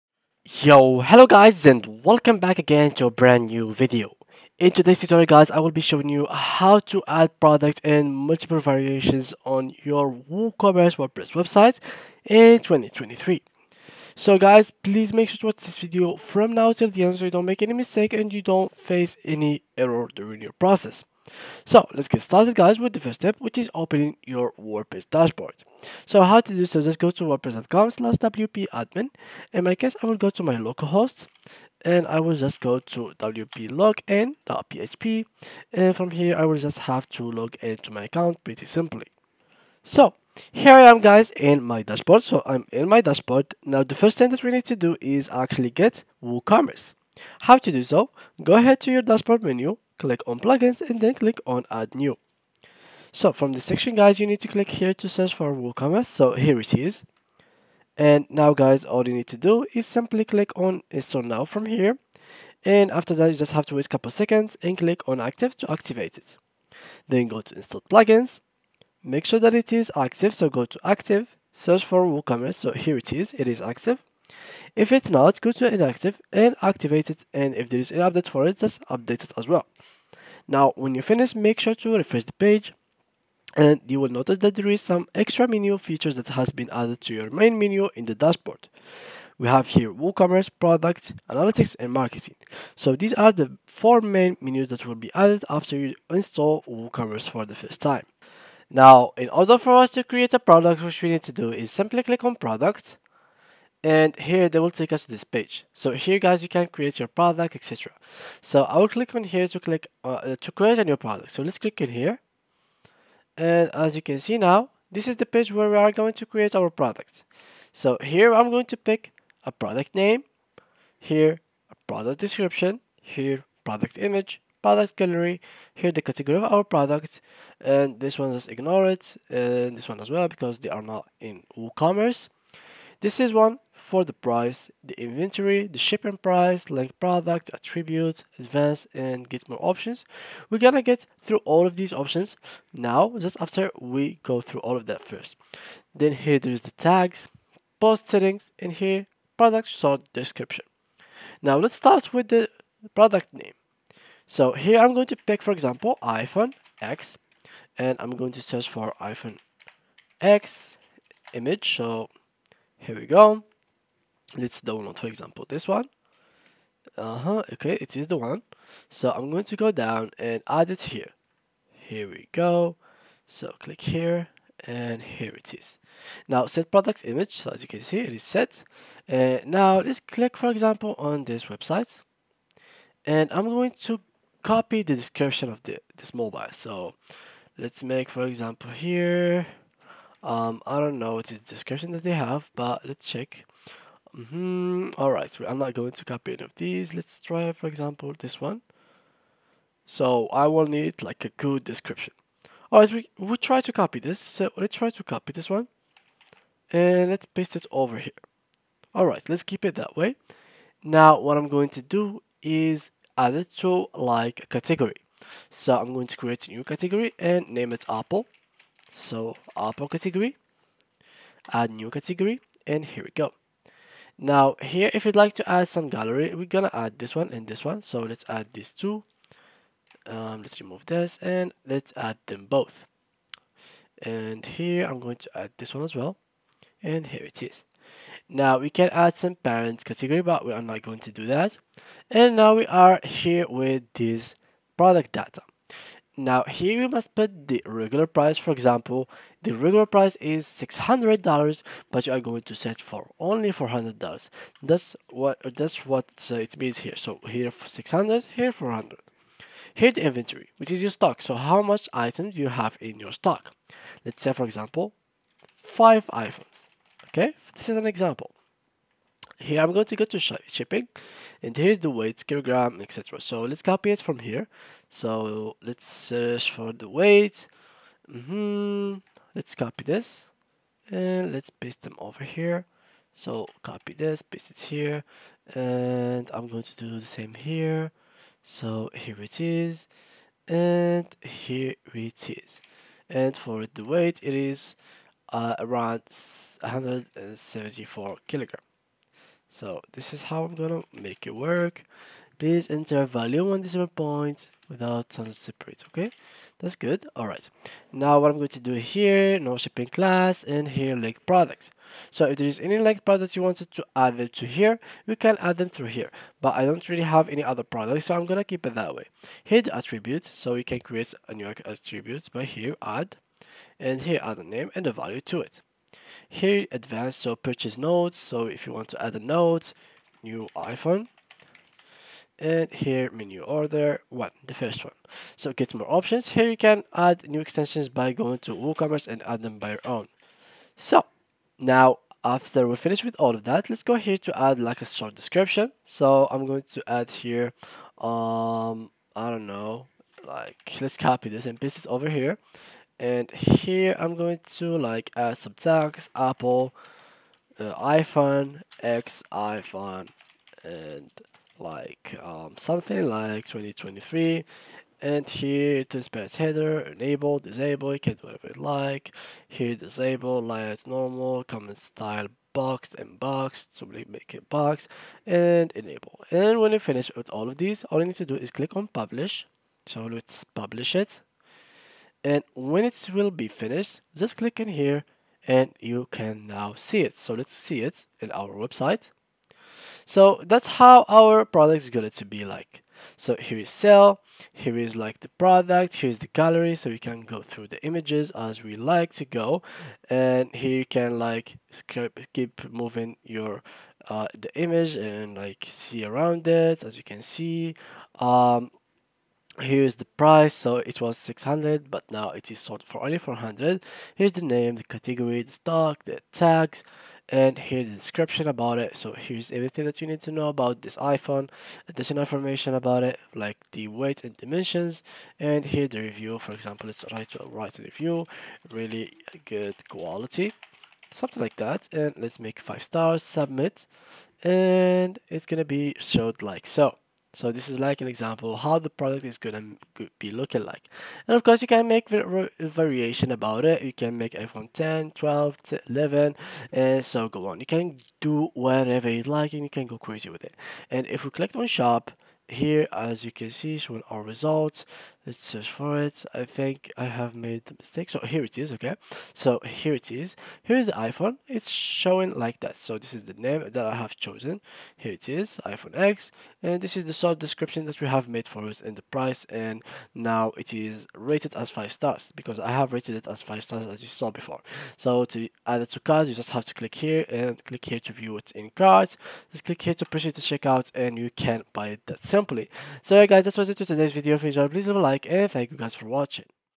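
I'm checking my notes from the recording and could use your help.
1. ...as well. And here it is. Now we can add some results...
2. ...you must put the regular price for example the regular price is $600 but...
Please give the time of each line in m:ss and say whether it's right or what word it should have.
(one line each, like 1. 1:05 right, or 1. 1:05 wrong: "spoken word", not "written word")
1. 3:55 wrong: "parents", not "results"
2. 4:06 right.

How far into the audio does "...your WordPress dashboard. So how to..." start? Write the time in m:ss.
0:24.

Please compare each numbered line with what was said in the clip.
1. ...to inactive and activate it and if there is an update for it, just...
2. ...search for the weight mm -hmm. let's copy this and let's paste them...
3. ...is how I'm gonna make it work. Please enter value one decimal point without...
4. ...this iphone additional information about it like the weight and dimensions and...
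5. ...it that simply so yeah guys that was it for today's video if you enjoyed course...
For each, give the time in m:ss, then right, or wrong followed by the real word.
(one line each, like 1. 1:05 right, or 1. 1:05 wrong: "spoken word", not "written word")
1. 1:15 right
2. 4:35 right
3. 5:00 right
4. 7:00 right
5. 8:01 wrong: "please", not "course".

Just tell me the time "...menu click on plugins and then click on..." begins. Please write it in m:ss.
0:49.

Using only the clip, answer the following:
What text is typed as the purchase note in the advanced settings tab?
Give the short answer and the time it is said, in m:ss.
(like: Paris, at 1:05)
new iPhone, at 5:30.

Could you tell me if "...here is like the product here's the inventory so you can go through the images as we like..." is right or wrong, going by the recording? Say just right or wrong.
wrong.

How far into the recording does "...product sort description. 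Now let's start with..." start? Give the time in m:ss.
2:29.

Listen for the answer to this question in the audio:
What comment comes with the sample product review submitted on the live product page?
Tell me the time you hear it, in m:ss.
7:08.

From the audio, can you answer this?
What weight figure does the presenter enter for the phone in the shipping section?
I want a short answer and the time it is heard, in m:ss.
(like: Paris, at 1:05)
174, at 4:56.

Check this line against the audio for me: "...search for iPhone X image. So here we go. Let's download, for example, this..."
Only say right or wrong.
right.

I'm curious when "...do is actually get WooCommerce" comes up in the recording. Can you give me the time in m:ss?
0:44.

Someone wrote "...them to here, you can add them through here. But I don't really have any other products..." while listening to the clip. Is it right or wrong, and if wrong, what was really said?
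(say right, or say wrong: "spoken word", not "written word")
right.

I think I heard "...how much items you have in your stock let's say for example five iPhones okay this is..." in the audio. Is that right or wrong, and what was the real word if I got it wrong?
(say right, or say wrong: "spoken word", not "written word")
right.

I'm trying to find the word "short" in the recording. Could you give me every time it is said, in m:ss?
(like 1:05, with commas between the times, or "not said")
5:44, 7:47.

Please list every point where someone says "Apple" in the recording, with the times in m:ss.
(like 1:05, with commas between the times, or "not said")
3:37, 5:56.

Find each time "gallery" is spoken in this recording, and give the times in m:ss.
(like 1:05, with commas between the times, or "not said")
2:04, 3:45, 6:36.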